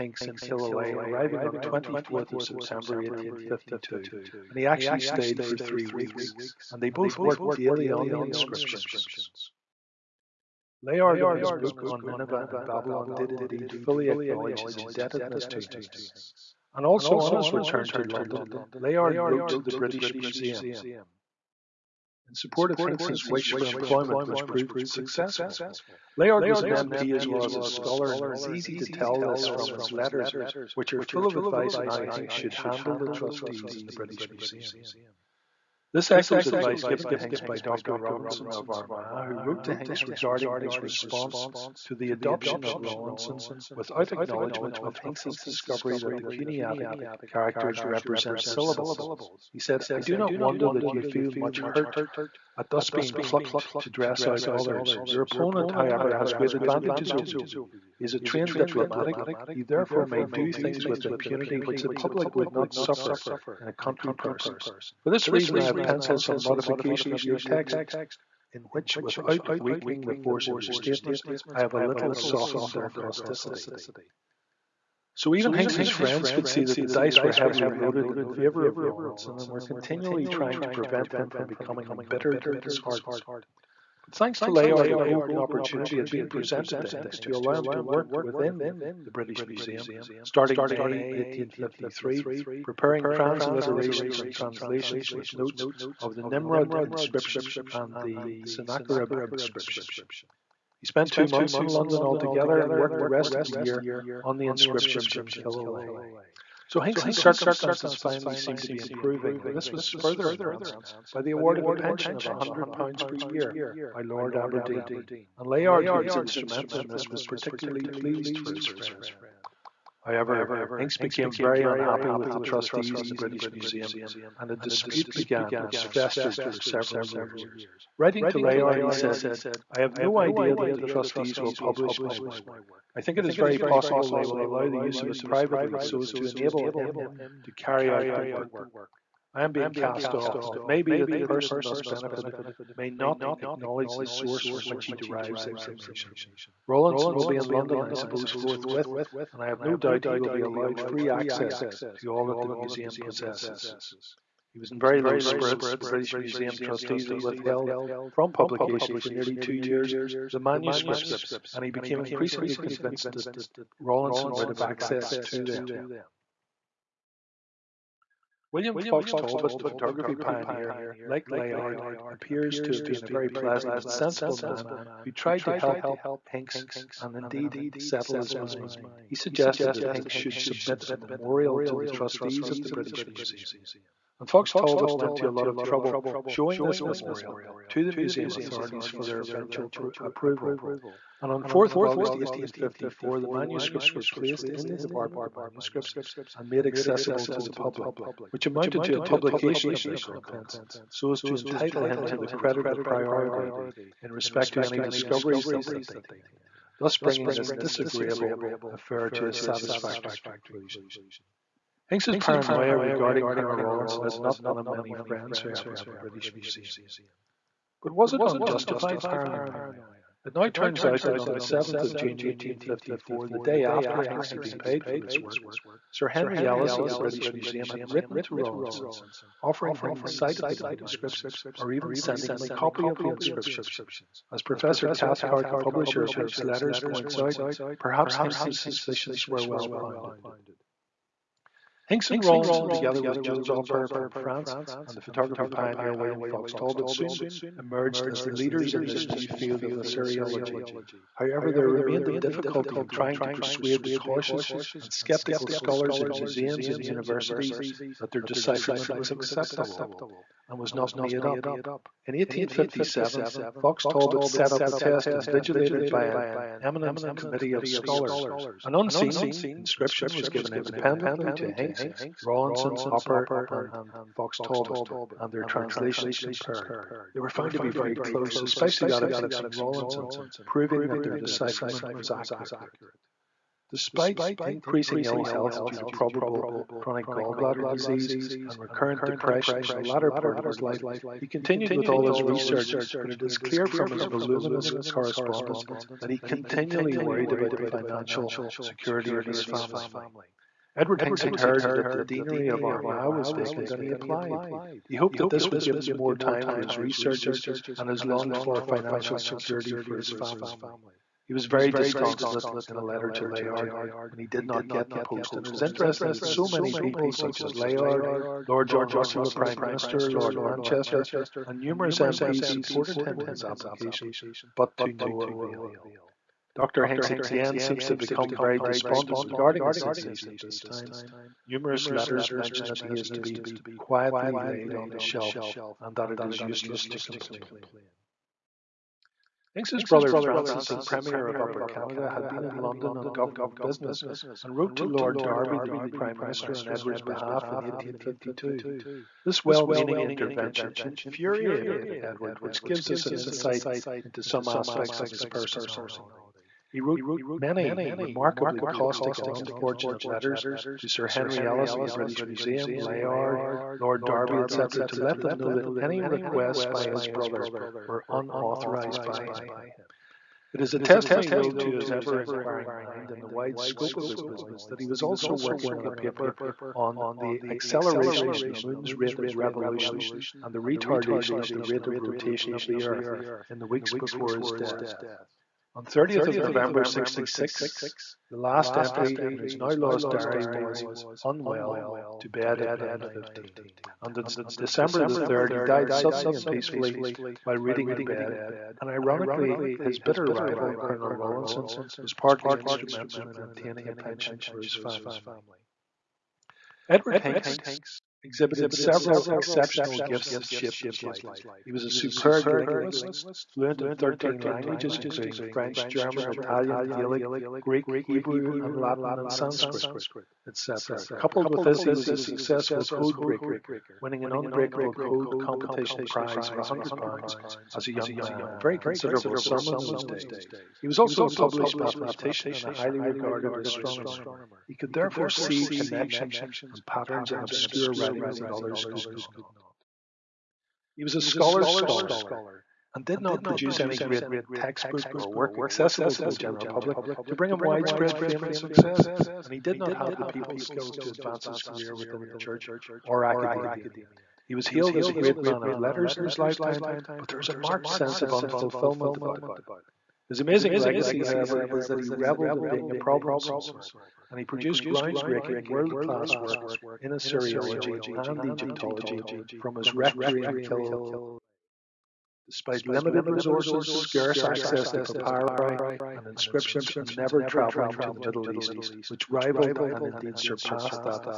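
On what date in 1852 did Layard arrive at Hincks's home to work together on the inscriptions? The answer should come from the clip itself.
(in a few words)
24 September 1852.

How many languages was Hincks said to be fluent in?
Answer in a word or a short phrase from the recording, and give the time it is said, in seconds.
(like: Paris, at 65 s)
13, at 413 s.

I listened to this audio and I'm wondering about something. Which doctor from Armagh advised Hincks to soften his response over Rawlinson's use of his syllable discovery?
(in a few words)
Dr. Robinson.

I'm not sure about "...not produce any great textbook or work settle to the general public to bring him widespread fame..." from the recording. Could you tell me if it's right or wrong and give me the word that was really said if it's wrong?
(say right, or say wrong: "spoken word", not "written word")
wrong: "accessible", not "settle".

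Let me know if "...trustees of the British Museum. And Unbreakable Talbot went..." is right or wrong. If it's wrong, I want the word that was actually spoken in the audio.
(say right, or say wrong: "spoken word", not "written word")
wrong: "Fox", not "Unbreakable".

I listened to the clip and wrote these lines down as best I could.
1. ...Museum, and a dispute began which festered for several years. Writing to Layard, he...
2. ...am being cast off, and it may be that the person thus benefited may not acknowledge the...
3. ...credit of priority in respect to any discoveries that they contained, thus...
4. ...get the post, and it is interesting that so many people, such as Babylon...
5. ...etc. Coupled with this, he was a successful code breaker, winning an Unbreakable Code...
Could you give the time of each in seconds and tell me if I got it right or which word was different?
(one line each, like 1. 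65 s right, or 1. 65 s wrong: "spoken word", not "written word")
1. 123 s right
2. 139 s right
3. 202 s right
4. 314 s wrong: "Layard", not "Babylon"
5. 420 s right.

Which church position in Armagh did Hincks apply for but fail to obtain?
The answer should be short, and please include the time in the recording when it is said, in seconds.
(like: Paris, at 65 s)
the deanery, at 301 s.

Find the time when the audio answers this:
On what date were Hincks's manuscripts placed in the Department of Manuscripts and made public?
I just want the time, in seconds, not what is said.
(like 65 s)
191 s.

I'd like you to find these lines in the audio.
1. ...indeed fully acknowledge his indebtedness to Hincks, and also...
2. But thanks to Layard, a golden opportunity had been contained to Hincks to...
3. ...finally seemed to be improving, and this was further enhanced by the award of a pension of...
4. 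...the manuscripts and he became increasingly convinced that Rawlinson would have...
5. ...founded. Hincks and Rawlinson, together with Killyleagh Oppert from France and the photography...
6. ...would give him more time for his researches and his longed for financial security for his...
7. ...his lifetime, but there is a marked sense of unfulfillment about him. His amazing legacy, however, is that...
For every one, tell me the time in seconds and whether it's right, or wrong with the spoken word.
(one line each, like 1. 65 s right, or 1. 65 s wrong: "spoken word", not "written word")
1. 13 s right
2. 84 s wrong: "presented", not "contained"
3. 107 s right
4. 160 s right
5. 239 s wrong: "Jules", not "Killyleagh"
6. 305 s right
7. 456 s right.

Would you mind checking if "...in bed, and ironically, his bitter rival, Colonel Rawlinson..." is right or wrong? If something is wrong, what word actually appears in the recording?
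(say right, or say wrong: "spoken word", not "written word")
right.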